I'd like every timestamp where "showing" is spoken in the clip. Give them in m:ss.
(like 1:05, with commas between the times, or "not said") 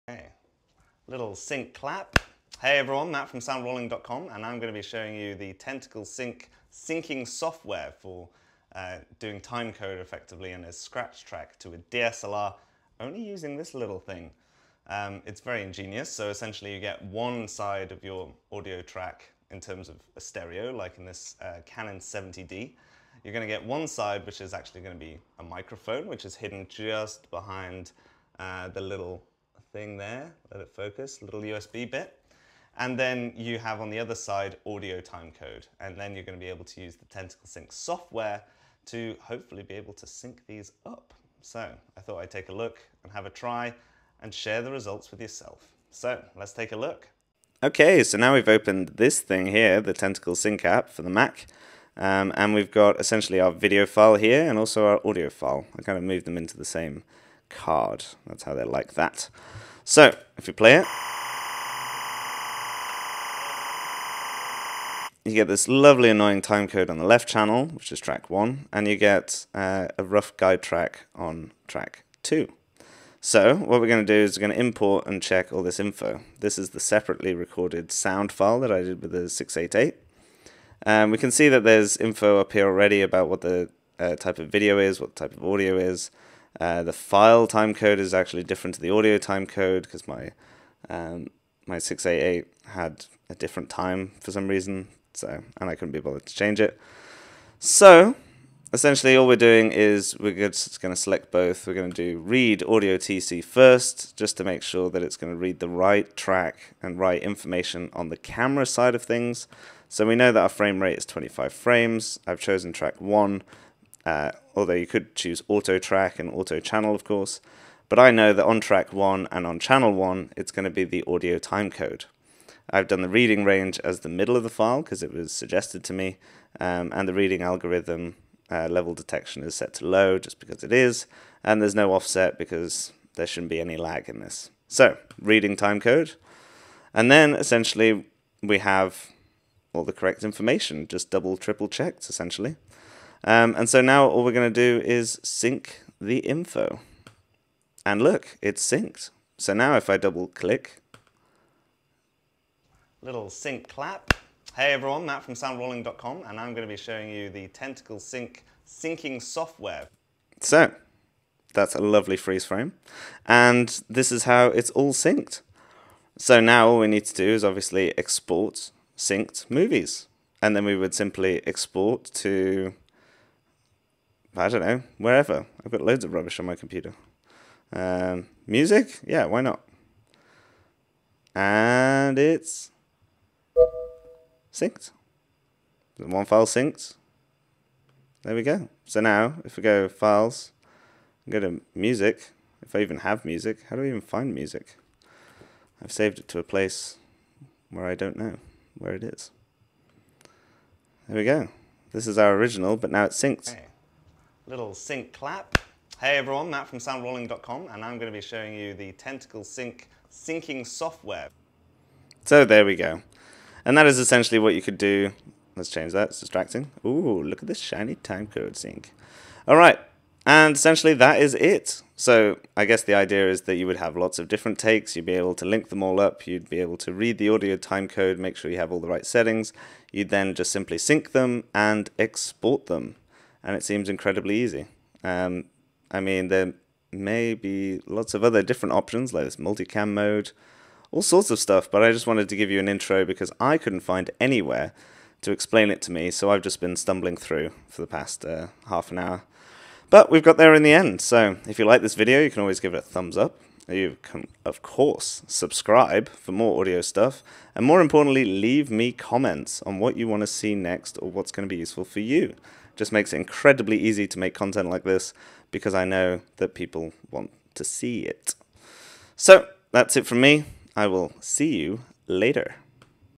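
0:04, 2:36, 3:28.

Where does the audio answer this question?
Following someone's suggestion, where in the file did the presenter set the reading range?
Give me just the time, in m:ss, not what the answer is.
2:04.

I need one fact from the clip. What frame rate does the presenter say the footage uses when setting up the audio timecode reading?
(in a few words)
25 frames.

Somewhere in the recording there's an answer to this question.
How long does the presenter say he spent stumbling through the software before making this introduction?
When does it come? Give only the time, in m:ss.
4:08.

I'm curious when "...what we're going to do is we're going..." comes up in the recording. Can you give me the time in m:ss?
1:13.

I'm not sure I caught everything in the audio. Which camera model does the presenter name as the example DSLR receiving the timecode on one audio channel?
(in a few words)
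Canon 70D.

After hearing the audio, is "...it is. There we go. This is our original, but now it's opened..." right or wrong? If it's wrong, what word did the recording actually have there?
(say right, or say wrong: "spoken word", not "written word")
wrong: "synced", not "opened".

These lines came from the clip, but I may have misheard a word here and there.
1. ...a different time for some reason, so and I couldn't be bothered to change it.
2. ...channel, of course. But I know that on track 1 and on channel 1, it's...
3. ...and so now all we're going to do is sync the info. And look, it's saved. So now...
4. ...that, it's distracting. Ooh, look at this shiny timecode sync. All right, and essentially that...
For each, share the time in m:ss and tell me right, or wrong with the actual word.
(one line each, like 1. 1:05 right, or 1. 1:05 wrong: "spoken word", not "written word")
1. 1:33 right
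2. 1:56 right
3. 2:23 wrong: "synced", not "saved"
4. 3:35 right.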